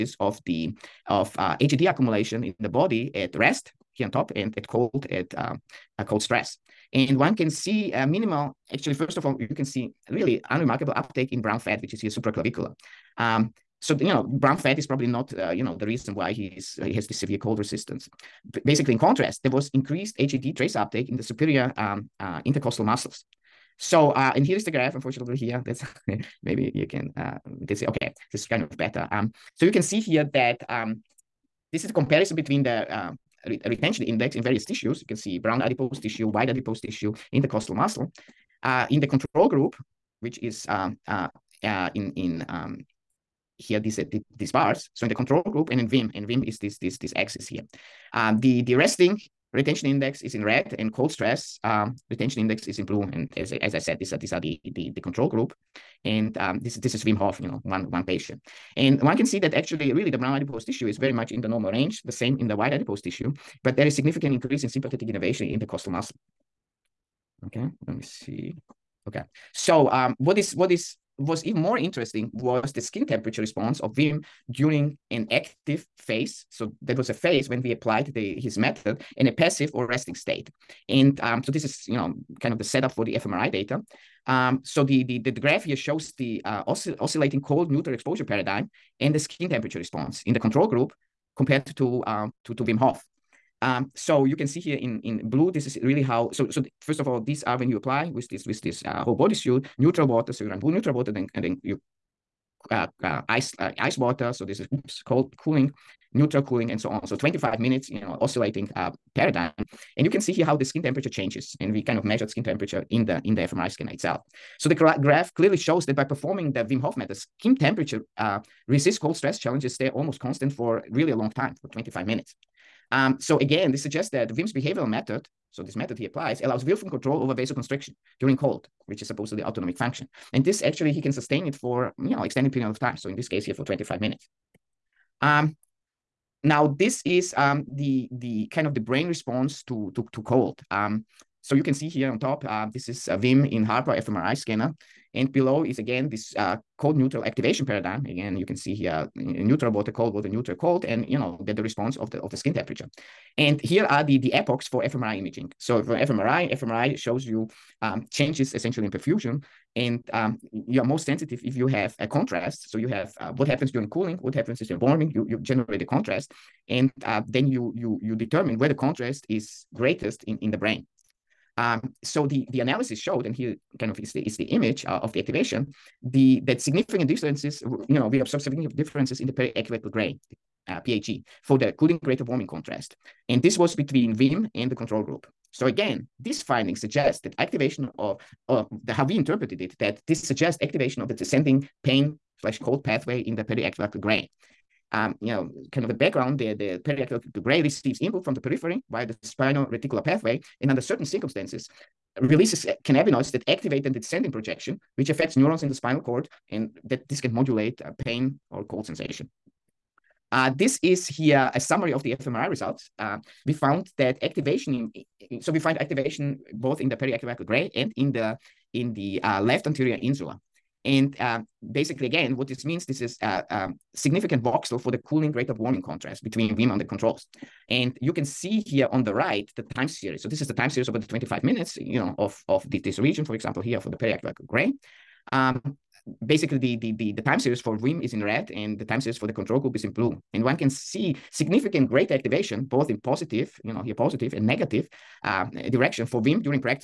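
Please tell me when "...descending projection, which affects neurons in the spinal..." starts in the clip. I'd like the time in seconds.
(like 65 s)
203 s.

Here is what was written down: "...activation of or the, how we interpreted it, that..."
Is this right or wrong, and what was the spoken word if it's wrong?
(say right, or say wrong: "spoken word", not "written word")
right.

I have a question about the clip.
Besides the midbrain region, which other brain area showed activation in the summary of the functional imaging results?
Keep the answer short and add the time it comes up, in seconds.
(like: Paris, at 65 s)
Left anterior insula, at 219 s.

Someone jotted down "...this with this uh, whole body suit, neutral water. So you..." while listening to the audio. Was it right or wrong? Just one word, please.
right.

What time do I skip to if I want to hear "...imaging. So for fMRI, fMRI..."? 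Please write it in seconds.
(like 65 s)
155 s.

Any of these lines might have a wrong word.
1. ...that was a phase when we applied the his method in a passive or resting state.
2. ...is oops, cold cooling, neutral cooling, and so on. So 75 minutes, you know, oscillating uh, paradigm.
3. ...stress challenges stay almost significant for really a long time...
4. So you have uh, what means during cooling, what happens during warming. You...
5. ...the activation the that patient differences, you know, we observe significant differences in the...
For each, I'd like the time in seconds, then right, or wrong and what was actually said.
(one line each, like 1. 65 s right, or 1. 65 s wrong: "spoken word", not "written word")
1. 76 s right
2. 104 s wrong: "25", not "75"
3. 119 s wrong: "constant", not "significant"
4. 162 s wrong: "happens", not "means"
5. 175 s wrong: "significant", not "patient".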